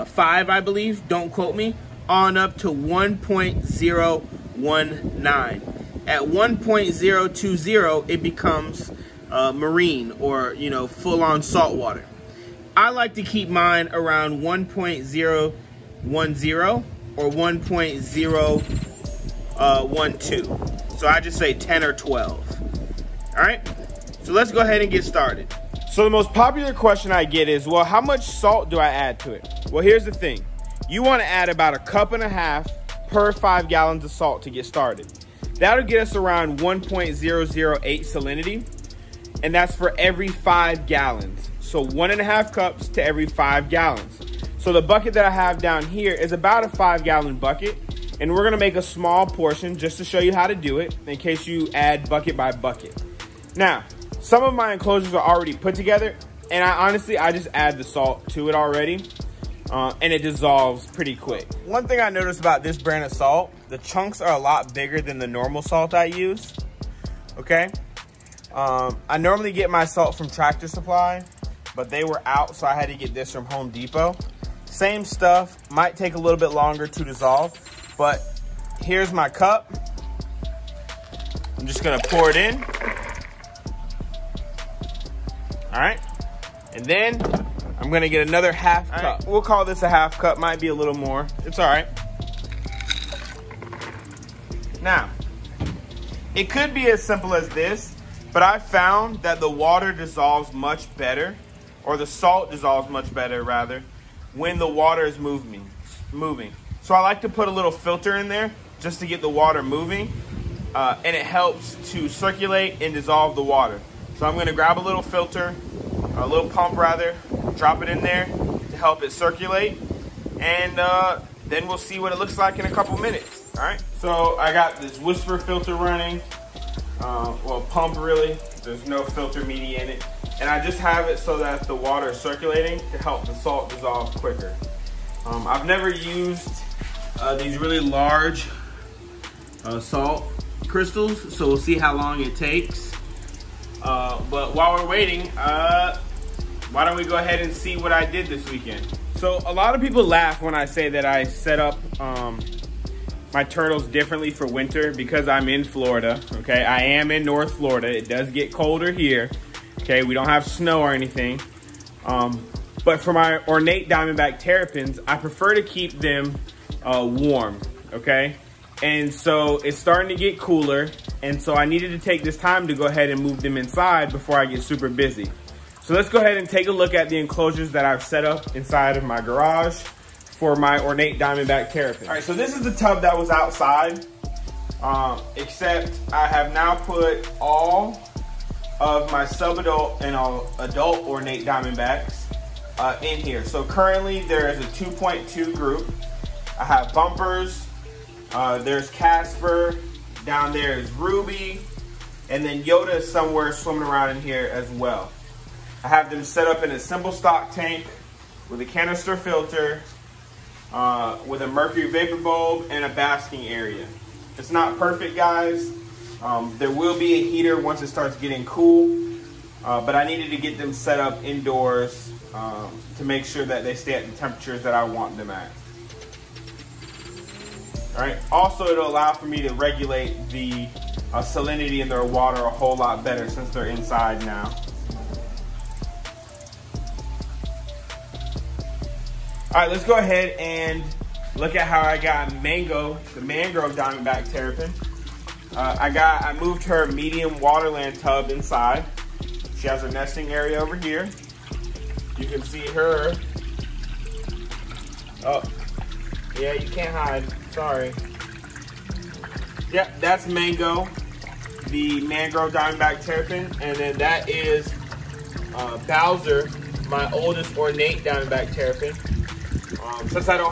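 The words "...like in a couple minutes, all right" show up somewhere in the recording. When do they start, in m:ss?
2:02.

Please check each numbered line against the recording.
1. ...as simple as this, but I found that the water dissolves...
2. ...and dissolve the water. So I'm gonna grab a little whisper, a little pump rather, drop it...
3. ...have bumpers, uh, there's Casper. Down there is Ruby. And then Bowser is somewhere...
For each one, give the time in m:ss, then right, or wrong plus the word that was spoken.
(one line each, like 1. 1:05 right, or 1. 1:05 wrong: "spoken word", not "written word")
1. 1:36 right
2. 1:52 wrong: "filter", not "whisper"
3. 3:16 wrong: "Yoda", not "Bowser".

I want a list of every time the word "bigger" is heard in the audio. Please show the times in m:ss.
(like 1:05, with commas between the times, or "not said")
1:04.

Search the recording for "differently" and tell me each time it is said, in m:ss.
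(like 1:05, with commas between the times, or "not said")
2:33.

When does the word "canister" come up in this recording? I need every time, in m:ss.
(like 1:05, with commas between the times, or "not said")
3:28.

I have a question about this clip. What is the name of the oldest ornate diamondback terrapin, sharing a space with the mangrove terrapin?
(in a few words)
Bowser.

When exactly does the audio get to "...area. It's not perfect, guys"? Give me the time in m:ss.
3:33.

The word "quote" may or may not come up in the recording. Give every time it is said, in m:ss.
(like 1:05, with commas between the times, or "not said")
0:01.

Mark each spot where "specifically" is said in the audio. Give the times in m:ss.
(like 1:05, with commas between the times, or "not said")
not said.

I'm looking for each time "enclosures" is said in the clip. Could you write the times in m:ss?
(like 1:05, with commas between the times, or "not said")
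0:54, 2:57.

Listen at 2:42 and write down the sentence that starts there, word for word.
Um, but for my ornate diamondback terrapins, I prefer to keep them uh, warm.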